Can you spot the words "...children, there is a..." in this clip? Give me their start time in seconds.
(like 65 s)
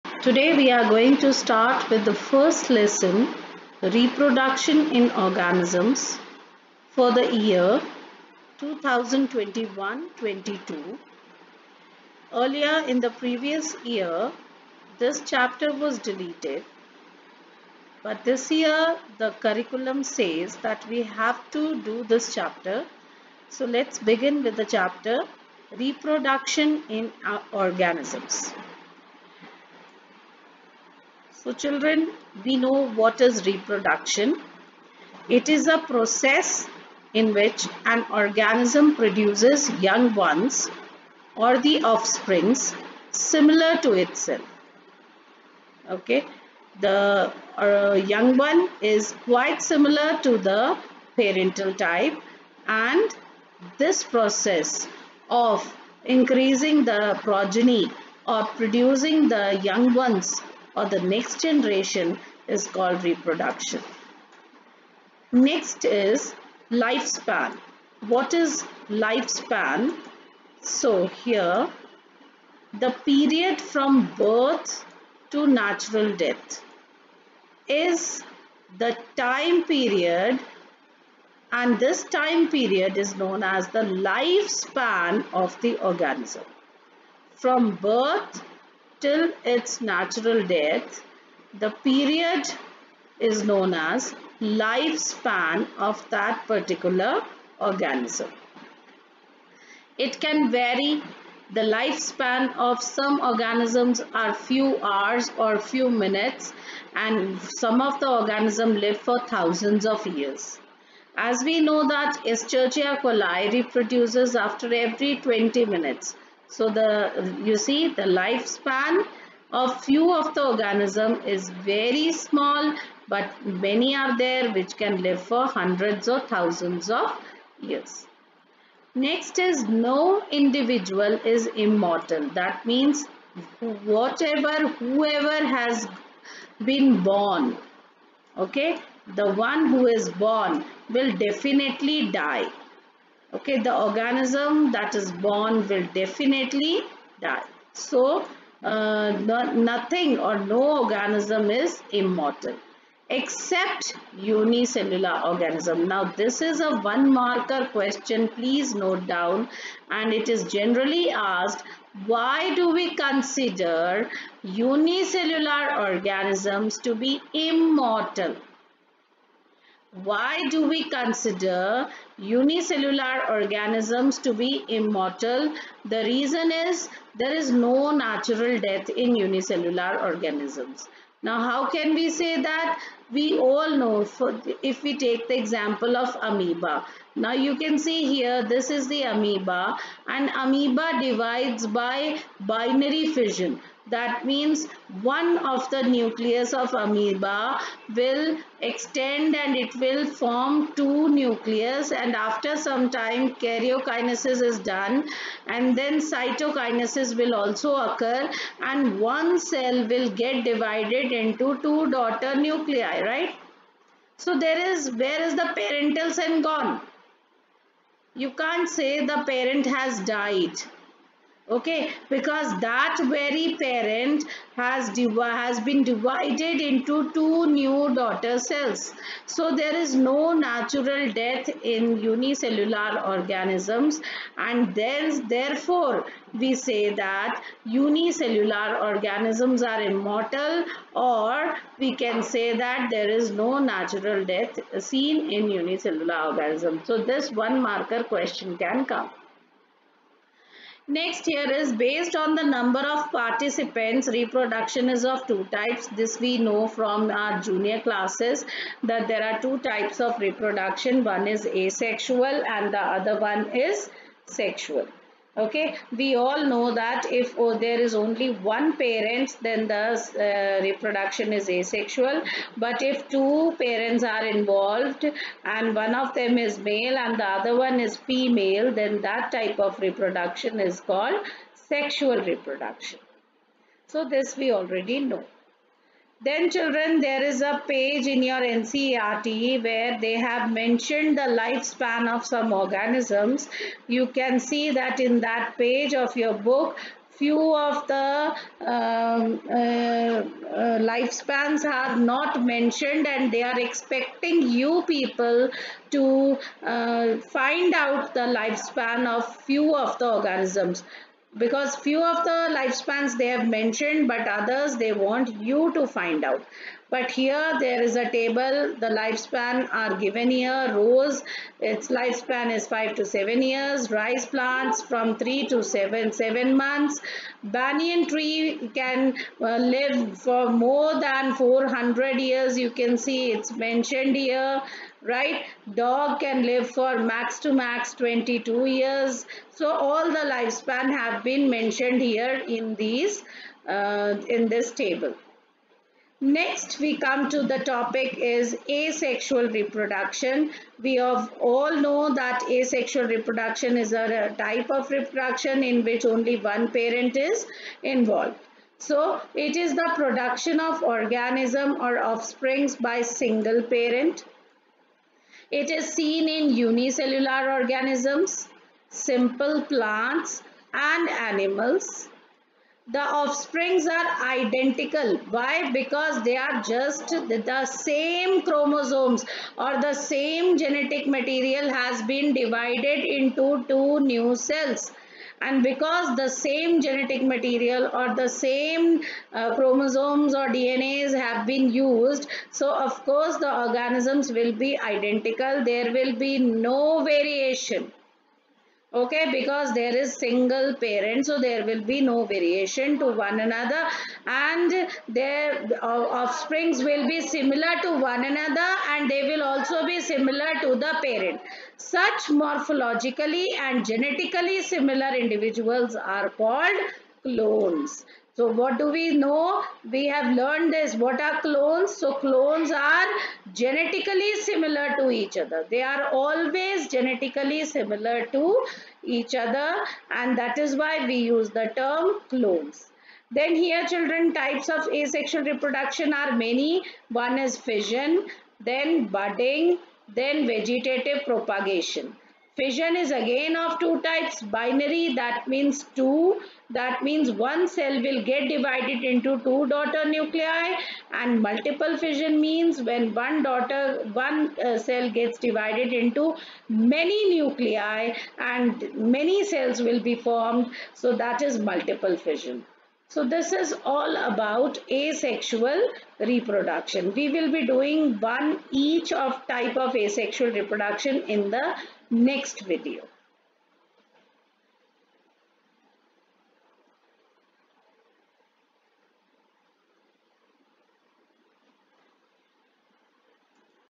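286 s.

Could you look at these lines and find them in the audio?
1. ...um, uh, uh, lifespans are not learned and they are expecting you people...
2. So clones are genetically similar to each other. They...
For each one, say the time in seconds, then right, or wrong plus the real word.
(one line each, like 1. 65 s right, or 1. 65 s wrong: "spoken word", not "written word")
1. 298 s wrong: "mentioned", not "learned"
2. 421 s right.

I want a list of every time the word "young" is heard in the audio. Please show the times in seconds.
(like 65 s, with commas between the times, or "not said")
39 s, 48 s, 59 s.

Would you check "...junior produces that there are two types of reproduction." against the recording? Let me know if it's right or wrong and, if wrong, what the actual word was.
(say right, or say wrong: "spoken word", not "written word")
wrong: "classes", not "produces".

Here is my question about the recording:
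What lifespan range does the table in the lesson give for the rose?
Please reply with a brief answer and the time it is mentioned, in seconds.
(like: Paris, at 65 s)
5 to 7 years, at 322 s.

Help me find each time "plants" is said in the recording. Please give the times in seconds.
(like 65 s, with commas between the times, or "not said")
324 s, 369 s.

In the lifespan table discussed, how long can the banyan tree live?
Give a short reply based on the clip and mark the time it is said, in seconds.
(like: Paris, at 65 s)
More than 400 years, at 330 s.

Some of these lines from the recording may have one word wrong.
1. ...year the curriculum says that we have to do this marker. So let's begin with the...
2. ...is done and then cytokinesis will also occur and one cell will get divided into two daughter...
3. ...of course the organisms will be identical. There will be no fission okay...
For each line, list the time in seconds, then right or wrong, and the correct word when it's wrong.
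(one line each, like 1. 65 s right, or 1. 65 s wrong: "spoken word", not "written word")
1. 18 s wrong: "chapter", not "marker"
2. 204 s right
3. 392 s wrong: "variation", not "fission".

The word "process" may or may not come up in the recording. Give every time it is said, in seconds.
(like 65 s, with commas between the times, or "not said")
35 s, 54 s.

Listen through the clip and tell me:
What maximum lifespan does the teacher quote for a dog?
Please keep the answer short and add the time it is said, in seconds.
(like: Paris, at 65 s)
22 years, at 338 s.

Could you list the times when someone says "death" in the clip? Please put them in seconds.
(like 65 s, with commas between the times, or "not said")
76 s, 90 s, 178 s, 231 s, 244 s.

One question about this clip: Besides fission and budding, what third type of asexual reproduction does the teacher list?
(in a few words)
Vegetative propagation.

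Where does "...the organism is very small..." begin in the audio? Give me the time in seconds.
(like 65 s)
120 s.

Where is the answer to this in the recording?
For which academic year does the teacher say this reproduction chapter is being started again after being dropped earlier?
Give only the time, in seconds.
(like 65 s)
8 s.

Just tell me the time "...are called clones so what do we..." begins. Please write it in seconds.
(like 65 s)
415 s.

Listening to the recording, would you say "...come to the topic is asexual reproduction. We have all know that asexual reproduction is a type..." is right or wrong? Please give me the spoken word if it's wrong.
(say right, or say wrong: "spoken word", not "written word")
right.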